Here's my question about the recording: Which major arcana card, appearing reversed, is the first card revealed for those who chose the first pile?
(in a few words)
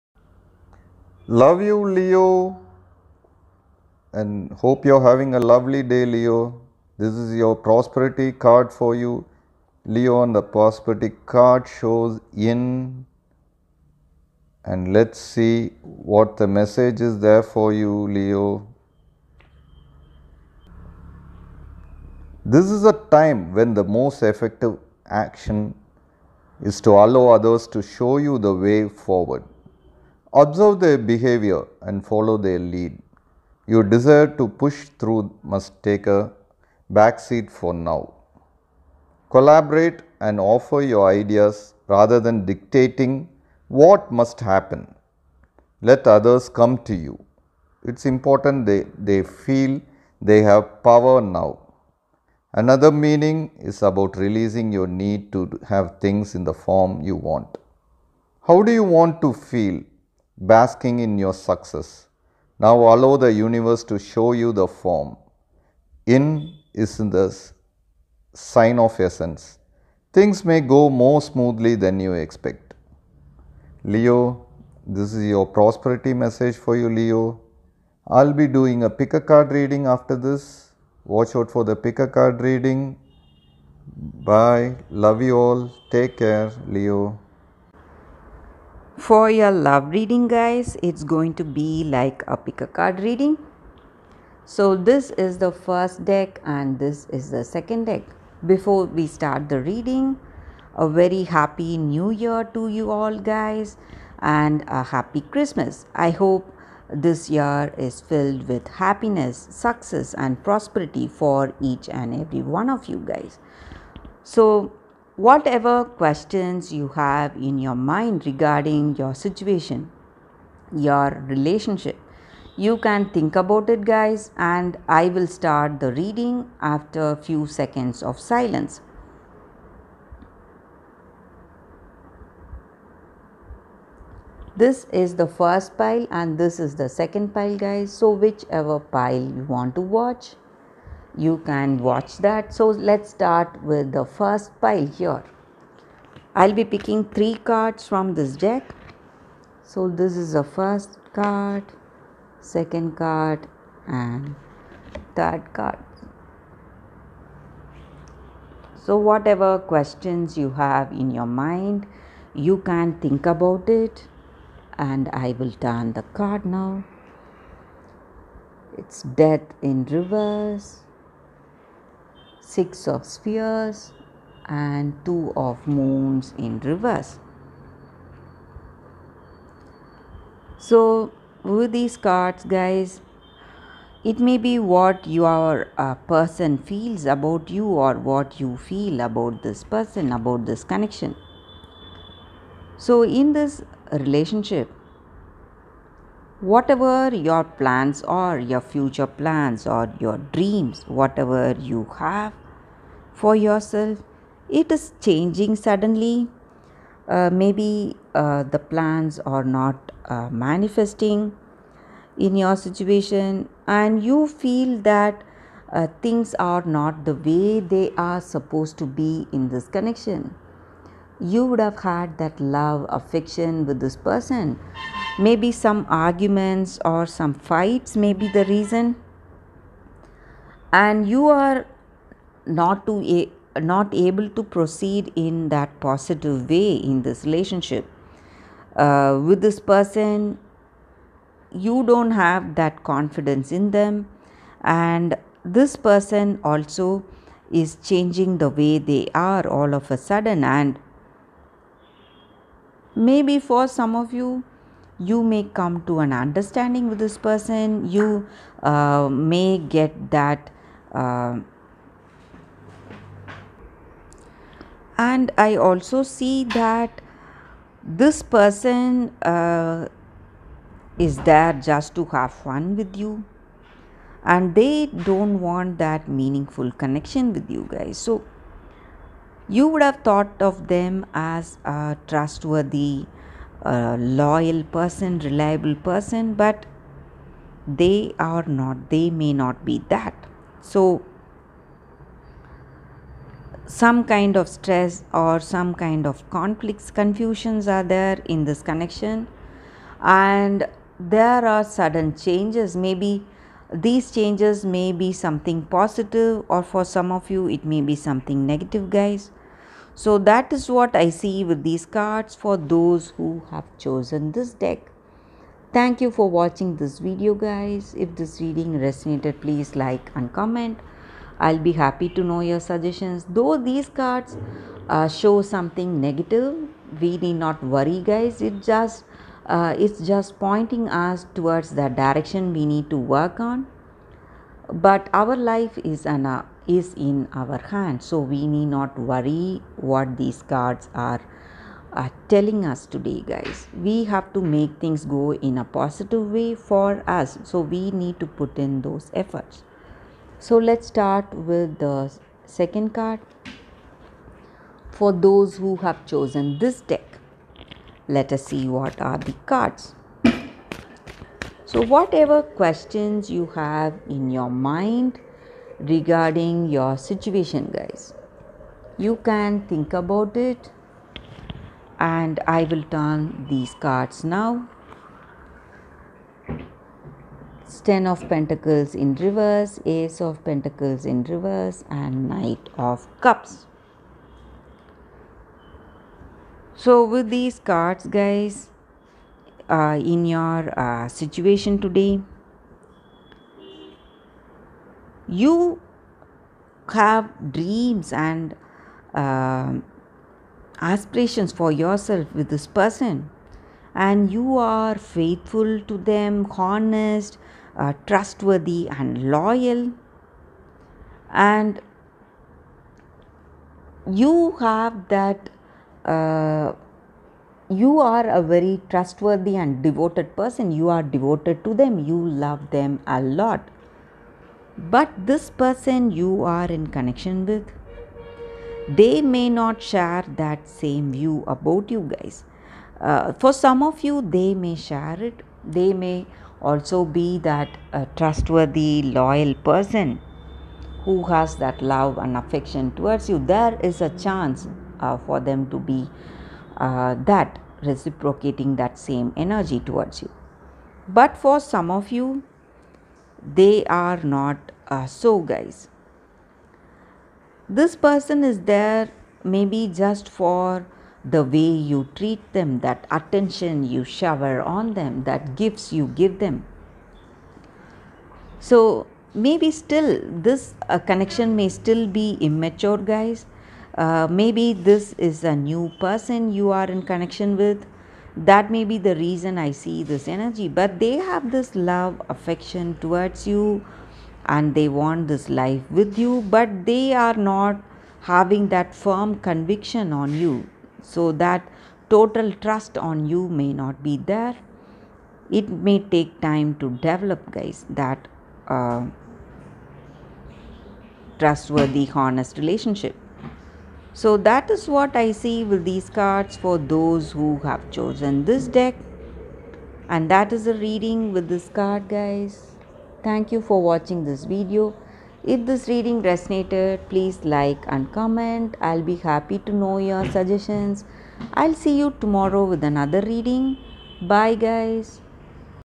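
Death.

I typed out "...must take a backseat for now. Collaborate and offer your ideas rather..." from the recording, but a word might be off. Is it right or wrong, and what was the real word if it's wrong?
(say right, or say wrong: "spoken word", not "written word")
right.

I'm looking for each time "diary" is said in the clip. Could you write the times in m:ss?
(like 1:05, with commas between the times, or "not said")
not said.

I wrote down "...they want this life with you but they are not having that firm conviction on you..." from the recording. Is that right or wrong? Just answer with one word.
right.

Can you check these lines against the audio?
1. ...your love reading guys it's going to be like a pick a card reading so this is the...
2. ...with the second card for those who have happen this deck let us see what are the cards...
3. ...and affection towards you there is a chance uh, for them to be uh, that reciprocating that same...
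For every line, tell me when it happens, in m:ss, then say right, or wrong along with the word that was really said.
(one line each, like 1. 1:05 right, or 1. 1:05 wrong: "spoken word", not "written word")
1. 1:29 right
2. 5:51 wrong: "chosen", not "happen"
3. 7:22 right.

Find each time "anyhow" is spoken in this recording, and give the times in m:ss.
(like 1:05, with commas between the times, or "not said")
not said.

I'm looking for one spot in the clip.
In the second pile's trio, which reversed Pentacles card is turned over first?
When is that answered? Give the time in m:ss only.
6:17.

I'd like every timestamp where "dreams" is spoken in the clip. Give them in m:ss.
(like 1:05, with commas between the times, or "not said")
3:20, 6:37.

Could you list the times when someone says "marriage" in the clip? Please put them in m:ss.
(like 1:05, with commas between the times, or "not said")
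not said.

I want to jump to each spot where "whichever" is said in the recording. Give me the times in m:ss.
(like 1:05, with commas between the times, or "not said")
2:18.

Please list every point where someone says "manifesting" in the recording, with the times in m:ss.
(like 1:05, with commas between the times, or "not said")
3:30.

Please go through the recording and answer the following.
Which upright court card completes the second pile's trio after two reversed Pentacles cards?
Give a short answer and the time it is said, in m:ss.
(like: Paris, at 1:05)
Knight of Cups, at 6:22.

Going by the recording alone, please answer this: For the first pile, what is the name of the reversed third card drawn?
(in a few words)
Two of Moons.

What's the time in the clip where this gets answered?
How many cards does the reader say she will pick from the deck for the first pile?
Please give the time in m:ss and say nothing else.
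2:27.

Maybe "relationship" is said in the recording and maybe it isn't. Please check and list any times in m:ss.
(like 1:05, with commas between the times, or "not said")
2:01, 3:13, 3:57, 8:22.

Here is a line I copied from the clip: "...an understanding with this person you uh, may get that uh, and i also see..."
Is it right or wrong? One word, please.
right.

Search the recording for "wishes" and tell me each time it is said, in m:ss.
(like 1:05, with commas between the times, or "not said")
not said.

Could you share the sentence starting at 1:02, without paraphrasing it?
Now allow the universe to show you the form.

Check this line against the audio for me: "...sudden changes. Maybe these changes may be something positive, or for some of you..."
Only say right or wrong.
right.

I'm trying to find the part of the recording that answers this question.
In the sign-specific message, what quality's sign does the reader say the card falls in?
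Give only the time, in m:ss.
1:08.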